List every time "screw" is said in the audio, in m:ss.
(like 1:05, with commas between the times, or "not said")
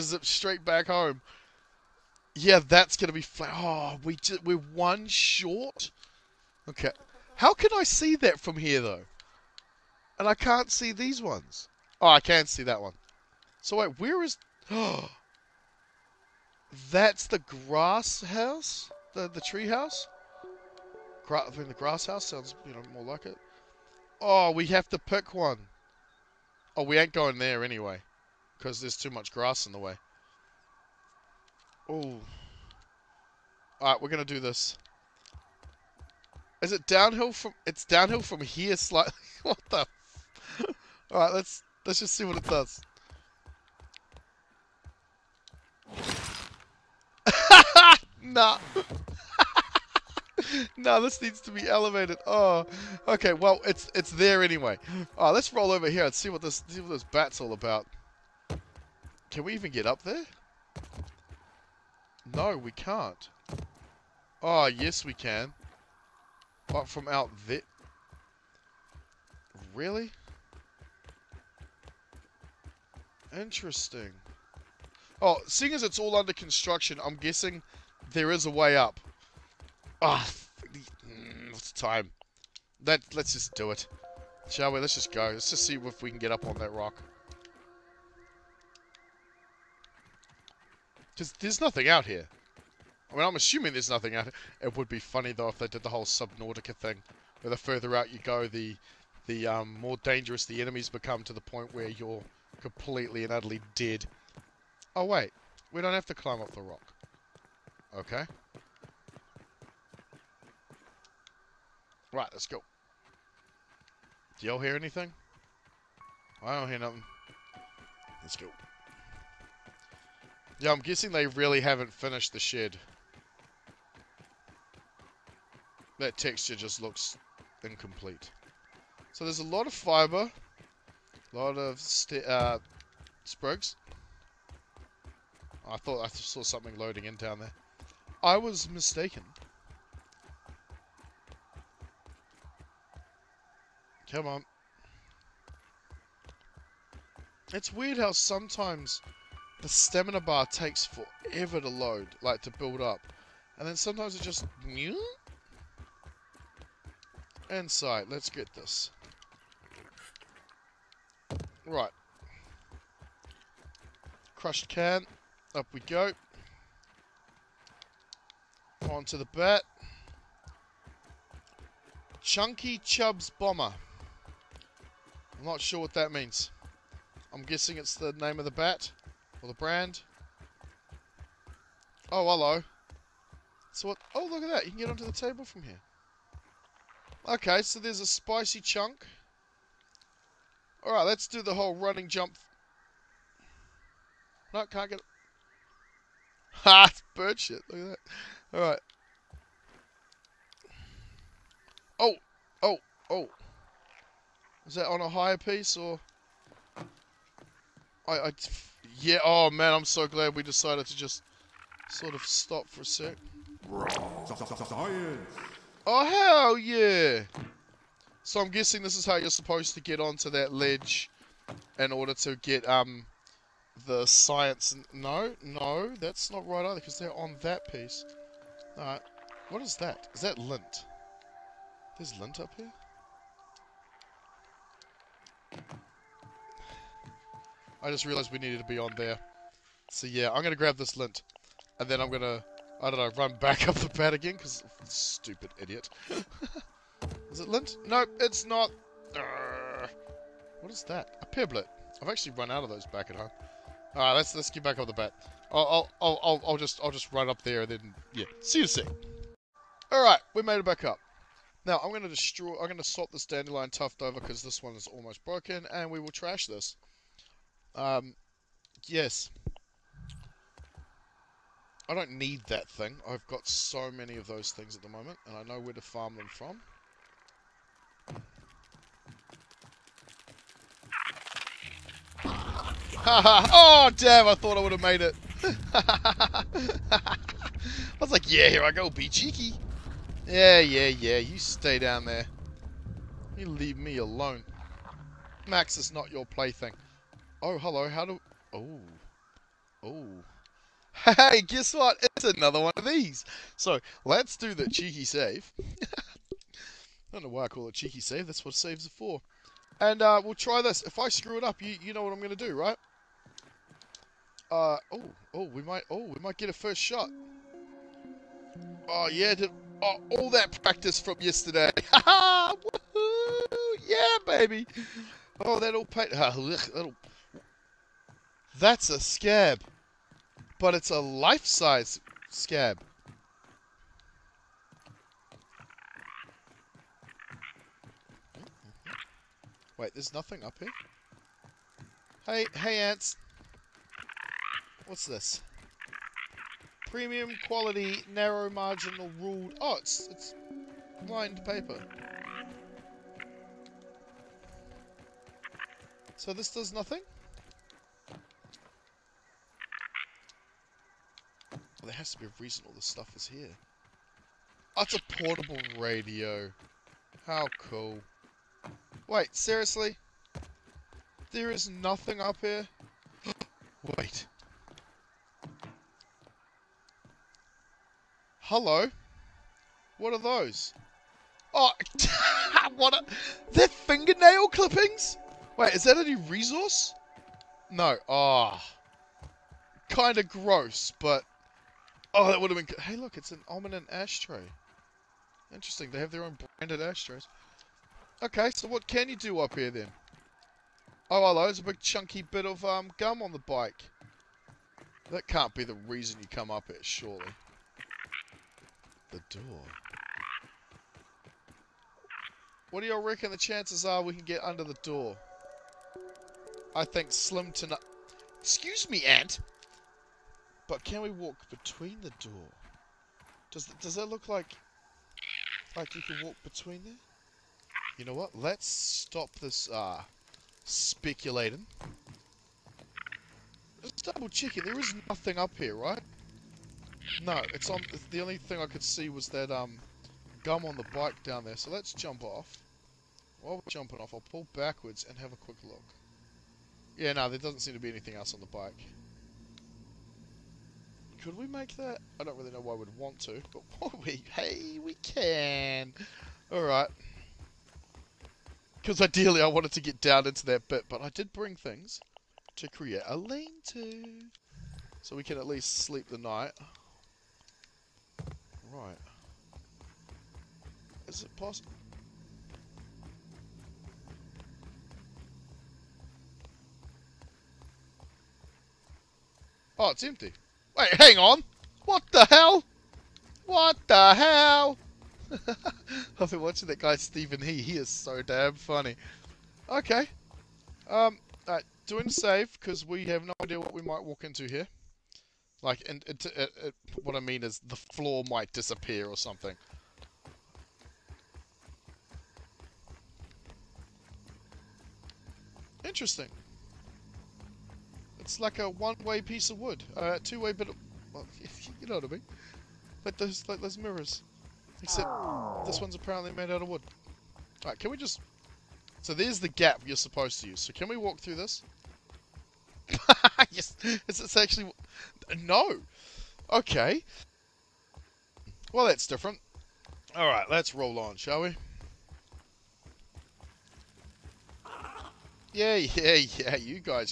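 5:11.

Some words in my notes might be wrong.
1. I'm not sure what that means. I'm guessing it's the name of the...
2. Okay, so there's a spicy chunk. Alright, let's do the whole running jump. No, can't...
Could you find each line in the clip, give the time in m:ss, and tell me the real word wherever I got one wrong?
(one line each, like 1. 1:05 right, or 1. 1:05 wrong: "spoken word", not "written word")
1. 2:55 right
2. 3:07 right.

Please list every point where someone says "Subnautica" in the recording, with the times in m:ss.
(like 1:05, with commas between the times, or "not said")
1:36.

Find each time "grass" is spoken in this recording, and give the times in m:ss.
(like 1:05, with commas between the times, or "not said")
0:17, 0:21, 0:29.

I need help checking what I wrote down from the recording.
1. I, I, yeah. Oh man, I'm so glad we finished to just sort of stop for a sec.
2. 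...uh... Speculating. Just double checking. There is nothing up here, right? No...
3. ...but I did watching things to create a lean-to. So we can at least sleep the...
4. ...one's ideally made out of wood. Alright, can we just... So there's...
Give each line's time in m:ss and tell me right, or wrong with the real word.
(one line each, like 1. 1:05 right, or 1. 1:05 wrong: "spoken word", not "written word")
1. 3:28 wrong: "decided", not "finished"
2. 7:09 right
3. 7:40 wrong: "bring", not "watching"
4. 8:35 wrong: "apparently", not "ideally".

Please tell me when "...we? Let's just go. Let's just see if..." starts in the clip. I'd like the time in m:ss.
1:24.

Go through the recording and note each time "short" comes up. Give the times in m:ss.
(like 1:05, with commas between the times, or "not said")
0:05.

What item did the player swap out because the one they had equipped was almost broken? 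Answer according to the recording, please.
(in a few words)
dandelion tuft.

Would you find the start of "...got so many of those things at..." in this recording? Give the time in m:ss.
4:33.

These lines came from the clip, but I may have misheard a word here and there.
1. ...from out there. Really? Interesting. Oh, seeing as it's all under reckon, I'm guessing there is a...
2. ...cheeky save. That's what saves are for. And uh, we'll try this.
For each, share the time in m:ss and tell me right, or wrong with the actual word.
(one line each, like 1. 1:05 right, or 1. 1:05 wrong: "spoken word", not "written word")
1. 1:06 wrong: "construction", not "reckon"
2. 5:07 right.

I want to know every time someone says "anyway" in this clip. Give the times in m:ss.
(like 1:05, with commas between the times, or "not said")
0:27, 0:54.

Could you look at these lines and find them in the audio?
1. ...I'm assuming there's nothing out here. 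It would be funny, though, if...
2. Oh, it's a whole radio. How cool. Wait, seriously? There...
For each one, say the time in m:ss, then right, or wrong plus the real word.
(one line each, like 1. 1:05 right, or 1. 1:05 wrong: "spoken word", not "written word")
1. 1:33 right
2. 6:04 wrong: "portable", not "whole".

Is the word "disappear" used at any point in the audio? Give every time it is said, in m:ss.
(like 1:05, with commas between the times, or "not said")
8:18.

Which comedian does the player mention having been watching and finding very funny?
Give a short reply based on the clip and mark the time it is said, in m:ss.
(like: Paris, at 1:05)
Steven He, at 8:06.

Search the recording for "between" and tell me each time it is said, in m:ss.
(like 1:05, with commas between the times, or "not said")
7:01, 7:06.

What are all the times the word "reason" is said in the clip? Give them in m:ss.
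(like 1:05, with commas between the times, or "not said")
6:02, 6:45.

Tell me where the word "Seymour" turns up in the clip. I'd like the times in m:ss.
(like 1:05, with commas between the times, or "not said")
not said.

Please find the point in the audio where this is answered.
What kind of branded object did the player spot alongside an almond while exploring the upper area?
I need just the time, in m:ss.
6:33.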